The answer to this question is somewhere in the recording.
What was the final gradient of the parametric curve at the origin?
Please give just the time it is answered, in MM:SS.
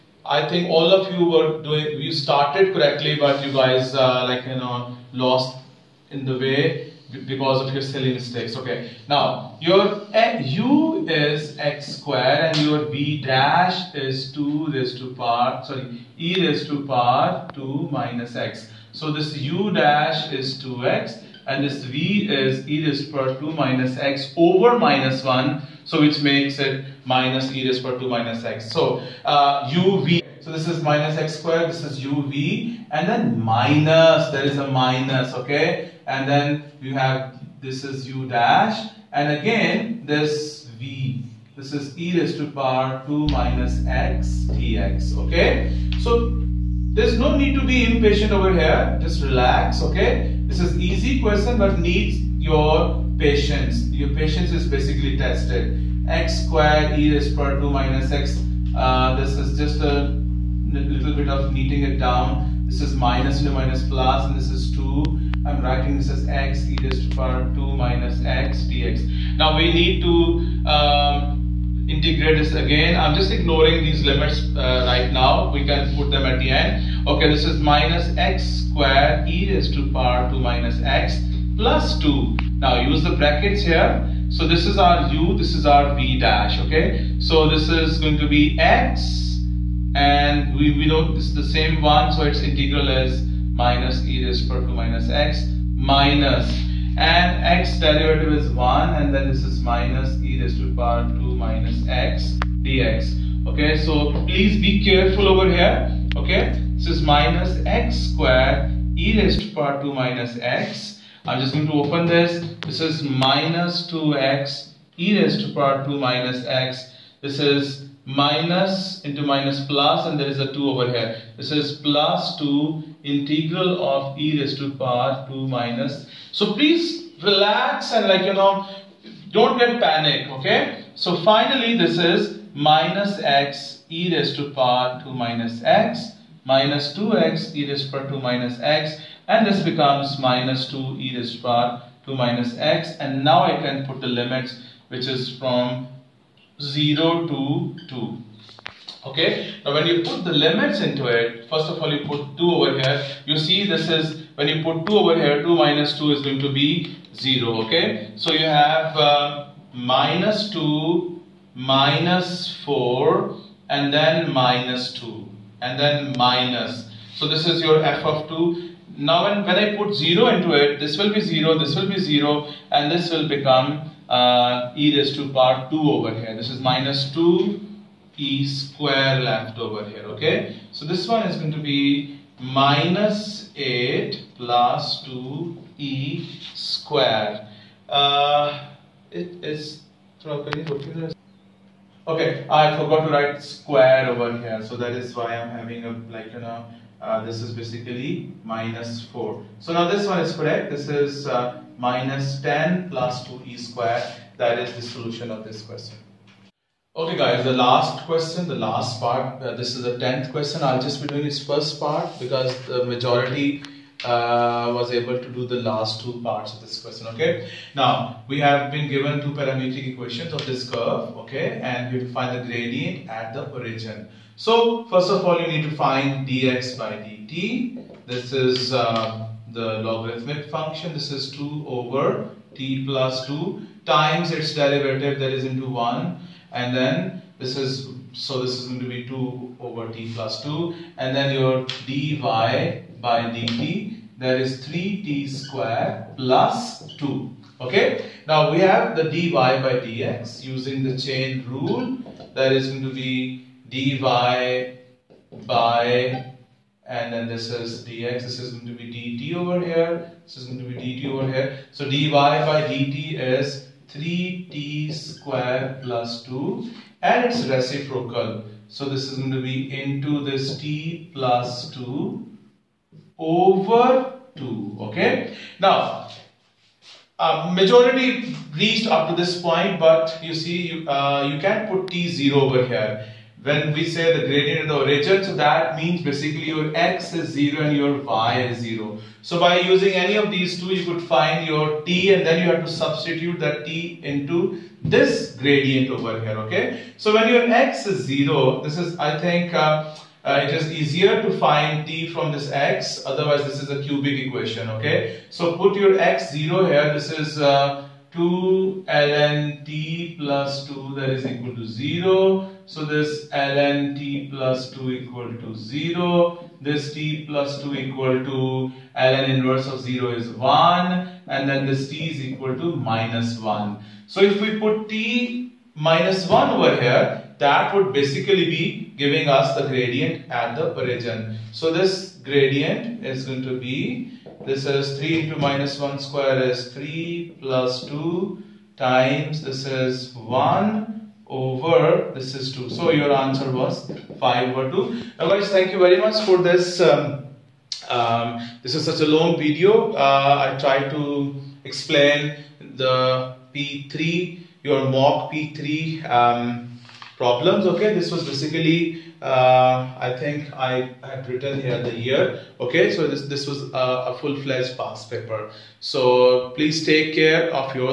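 05:44.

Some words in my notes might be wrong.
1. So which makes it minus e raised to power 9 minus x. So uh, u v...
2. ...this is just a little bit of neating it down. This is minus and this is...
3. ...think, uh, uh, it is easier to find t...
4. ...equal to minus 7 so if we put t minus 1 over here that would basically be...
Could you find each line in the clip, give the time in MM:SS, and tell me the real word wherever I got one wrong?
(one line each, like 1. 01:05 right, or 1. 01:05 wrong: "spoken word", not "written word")
1. 00:25 wrong: "2", not "9"
2. 00:59 right
3. 04:59 right
4. 05:22 wrong: "1", not "7".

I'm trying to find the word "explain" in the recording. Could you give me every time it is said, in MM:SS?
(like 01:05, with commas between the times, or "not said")
05:51.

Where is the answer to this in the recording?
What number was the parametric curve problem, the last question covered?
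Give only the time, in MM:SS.
03:29.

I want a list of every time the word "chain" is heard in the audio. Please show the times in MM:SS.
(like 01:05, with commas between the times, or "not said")
04:11.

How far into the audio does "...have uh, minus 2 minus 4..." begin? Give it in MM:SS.
02:38.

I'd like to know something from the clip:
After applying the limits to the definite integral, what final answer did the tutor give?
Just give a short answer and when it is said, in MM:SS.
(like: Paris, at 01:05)
-10 + 2e^2, at 03:21.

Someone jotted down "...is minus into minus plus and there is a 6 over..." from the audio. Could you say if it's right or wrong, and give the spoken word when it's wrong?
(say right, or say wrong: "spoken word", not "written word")
wrong: "2", not "6".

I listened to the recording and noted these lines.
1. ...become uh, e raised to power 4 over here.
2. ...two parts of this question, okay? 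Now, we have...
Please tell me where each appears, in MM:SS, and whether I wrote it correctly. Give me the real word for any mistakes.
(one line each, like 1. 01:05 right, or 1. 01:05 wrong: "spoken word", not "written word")
1. 02:53 wrong: "2", not "4"
2. 03:36 right.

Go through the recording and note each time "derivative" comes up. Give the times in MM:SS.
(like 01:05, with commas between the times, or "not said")
01:37, 03:54.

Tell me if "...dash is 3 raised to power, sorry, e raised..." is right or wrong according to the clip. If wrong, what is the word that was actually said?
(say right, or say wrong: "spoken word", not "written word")
wrong: "2", not "3".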